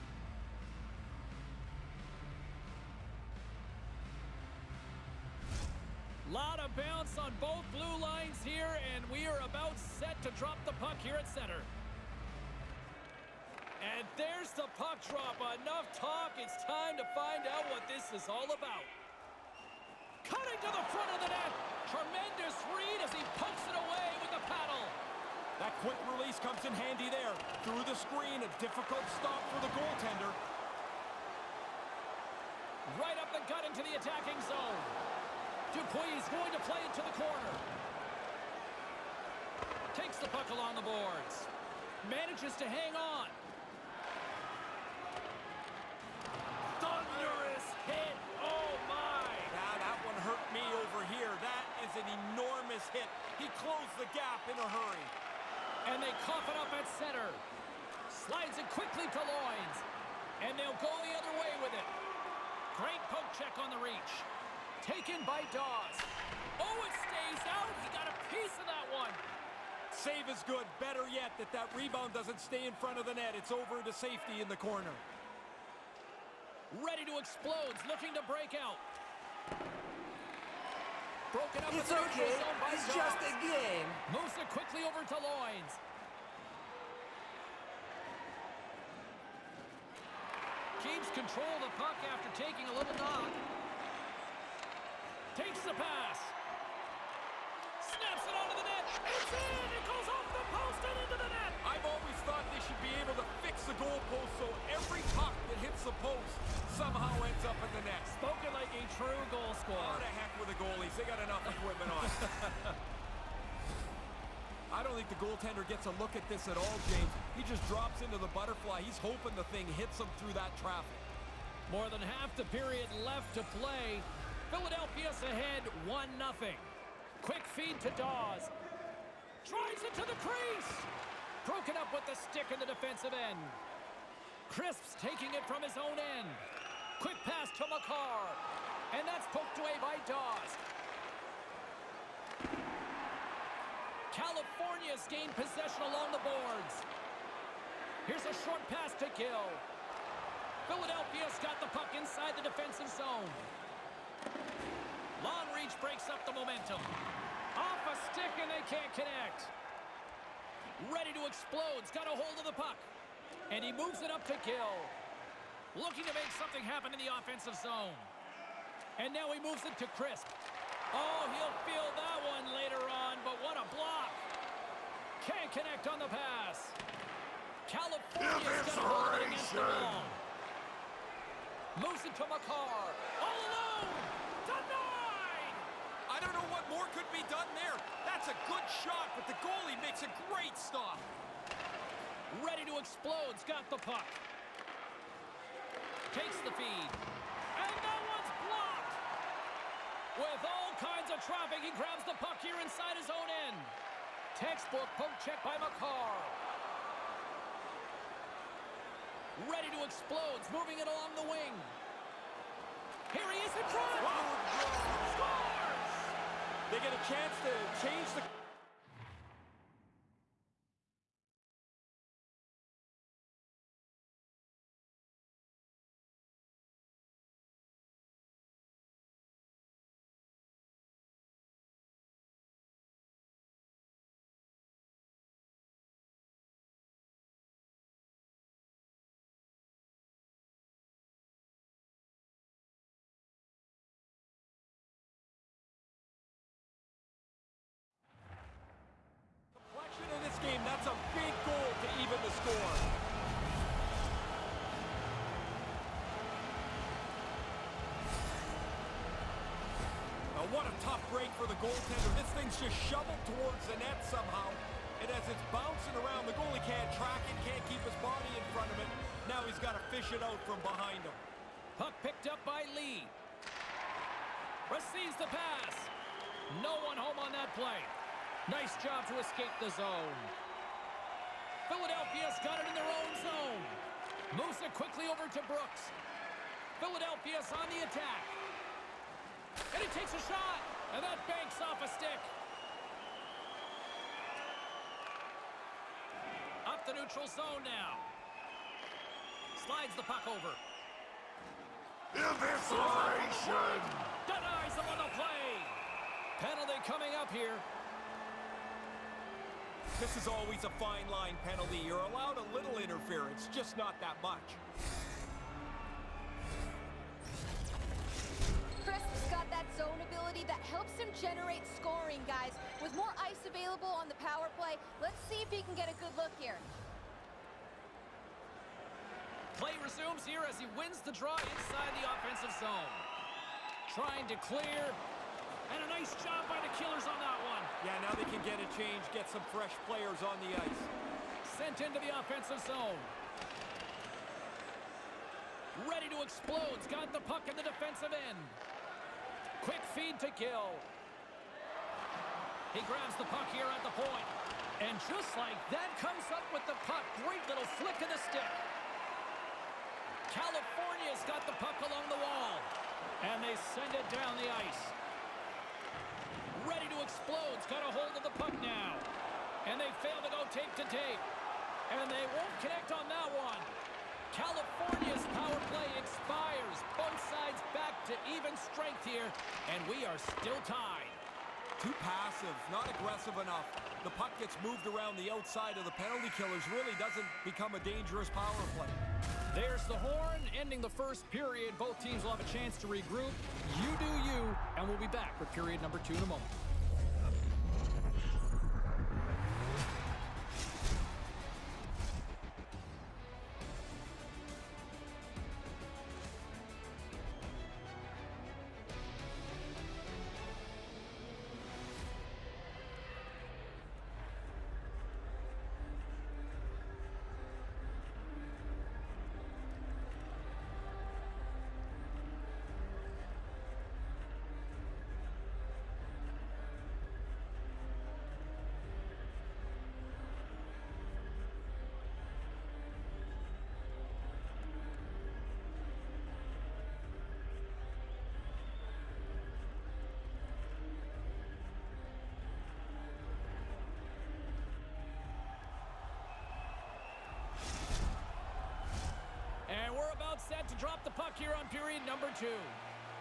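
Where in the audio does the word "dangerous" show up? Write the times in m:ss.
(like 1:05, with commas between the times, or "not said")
6:27.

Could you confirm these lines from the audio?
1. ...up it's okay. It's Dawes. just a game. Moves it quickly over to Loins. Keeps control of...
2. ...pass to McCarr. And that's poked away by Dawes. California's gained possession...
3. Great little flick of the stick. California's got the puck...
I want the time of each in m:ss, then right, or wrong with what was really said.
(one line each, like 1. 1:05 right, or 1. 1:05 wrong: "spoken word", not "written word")
1. 1:21 right
2. 2:17 right
3. 5:57 right.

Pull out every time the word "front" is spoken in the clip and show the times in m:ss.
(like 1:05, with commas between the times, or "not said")
0:20, 1:12, 3:33, 4:28.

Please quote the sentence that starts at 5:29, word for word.
Play resumes here as he wins the draw inside the offensive zone.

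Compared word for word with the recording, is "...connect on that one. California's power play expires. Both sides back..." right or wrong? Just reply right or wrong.
right.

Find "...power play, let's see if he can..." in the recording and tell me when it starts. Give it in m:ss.
5:24.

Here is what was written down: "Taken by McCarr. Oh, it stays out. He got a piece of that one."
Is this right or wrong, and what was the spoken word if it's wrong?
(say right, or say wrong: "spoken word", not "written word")
wrong: "Dawes", not "McCarr".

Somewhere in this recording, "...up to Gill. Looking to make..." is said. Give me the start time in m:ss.
2:44.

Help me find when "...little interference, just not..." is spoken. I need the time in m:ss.
5:12.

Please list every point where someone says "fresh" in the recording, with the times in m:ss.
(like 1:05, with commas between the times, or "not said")
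5:39.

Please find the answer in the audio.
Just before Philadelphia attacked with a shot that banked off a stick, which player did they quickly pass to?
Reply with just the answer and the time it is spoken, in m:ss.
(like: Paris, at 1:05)
Brooks, at 4:45.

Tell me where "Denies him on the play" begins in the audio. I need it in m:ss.
5:04.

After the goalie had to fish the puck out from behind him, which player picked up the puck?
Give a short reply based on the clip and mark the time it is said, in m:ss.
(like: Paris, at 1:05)
Lee, at 4:32.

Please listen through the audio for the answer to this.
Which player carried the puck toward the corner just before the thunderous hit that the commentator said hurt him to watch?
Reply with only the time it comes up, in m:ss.
0:35.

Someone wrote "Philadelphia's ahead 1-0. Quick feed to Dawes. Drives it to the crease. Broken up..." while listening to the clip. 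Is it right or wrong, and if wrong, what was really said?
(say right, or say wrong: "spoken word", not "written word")
right.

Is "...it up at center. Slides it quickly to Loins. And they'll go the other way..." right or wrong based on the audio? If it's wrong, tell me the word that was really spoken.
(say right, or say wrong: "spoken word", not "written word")
right.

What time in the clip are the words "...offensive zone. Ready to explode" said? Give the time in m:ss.
5:42.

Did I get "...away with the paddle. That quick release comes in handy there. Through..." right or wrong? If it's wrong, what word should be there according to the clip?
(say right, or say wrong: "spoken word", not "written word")
right.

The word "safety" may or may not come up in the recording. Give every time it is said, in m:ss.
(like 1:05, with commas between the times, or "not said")
1:13.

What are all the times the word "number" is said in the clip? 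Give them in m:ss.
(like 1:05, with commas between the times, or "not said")
6:35, 7:32.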